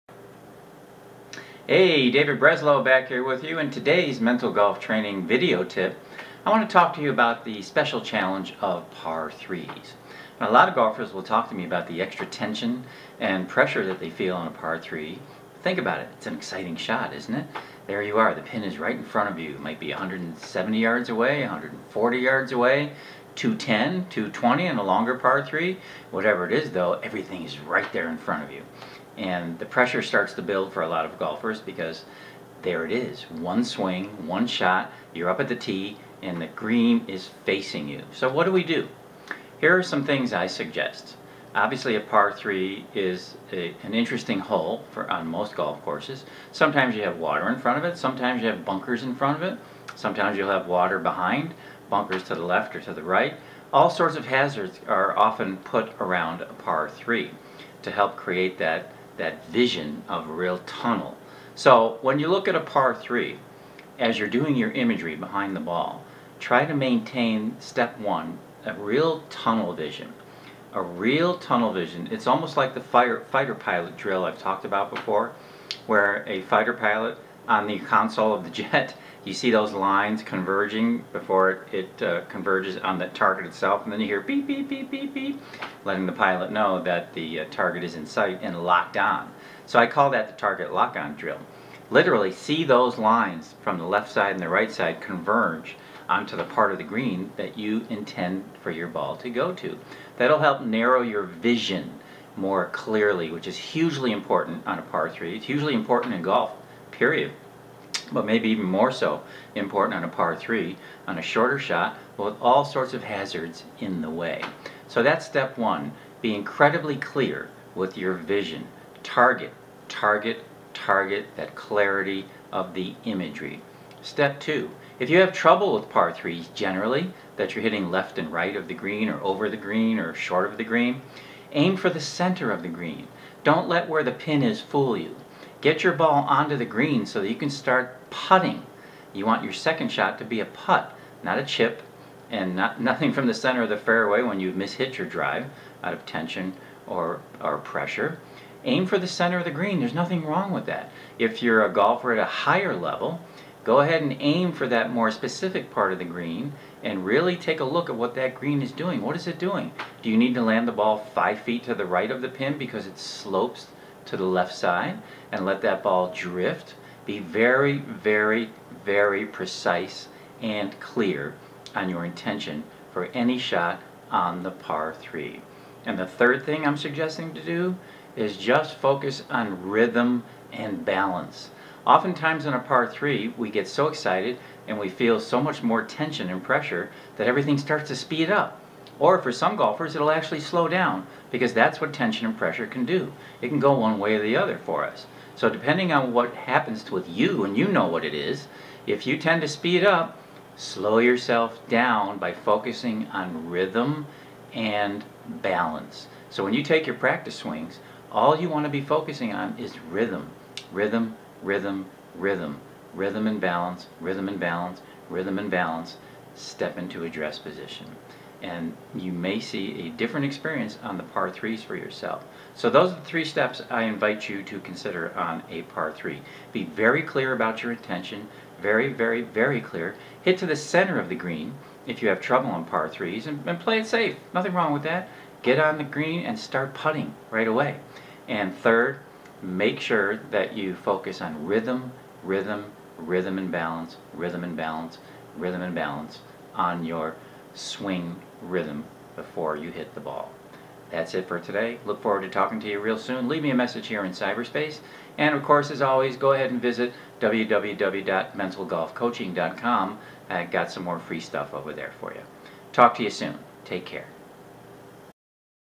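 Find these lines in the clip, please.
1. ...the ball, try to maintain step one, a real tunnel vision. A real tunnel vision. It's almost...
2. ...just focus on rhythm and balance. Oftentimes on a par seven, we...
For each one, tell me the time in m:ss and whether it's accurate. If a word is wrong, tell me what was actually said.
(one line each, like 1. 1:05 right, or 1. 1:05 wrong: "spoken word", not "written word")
1. 1:05 right
2. 2:58 wrong: "three", not "seven".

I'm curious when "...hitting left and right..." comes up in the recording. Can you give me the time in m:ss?
2:07.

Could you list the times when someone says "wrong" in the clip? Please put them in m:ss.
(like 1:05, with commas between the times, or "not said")
2:30, 3:54.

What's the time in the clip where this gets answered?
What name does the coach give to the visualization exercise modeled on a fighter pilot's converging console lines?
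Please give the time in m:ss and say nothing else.
1:30.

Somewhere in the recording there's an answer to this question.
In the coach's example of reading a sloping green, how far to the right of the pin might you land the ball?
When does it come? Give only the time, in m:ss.
2:41.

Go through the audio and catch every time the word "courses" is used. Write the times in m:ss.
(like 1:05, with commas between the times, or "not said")
0:45, 4:15.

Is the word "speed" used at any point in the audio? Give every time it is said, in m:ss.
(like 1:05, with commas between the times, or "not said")
3:07, 3:19.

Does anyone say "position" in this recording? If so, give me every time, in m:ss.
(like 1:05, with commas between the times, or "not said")
3:37.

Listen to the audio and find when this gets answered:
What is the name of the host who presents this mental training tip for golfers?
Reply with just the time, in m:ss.
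0:02.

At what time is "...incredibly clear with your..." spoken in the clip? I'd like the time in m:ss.
1:56.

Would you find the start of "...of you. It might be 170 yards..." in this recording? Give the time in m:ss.
0:19.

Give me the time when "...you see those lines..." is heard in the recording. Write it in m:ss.
1:19.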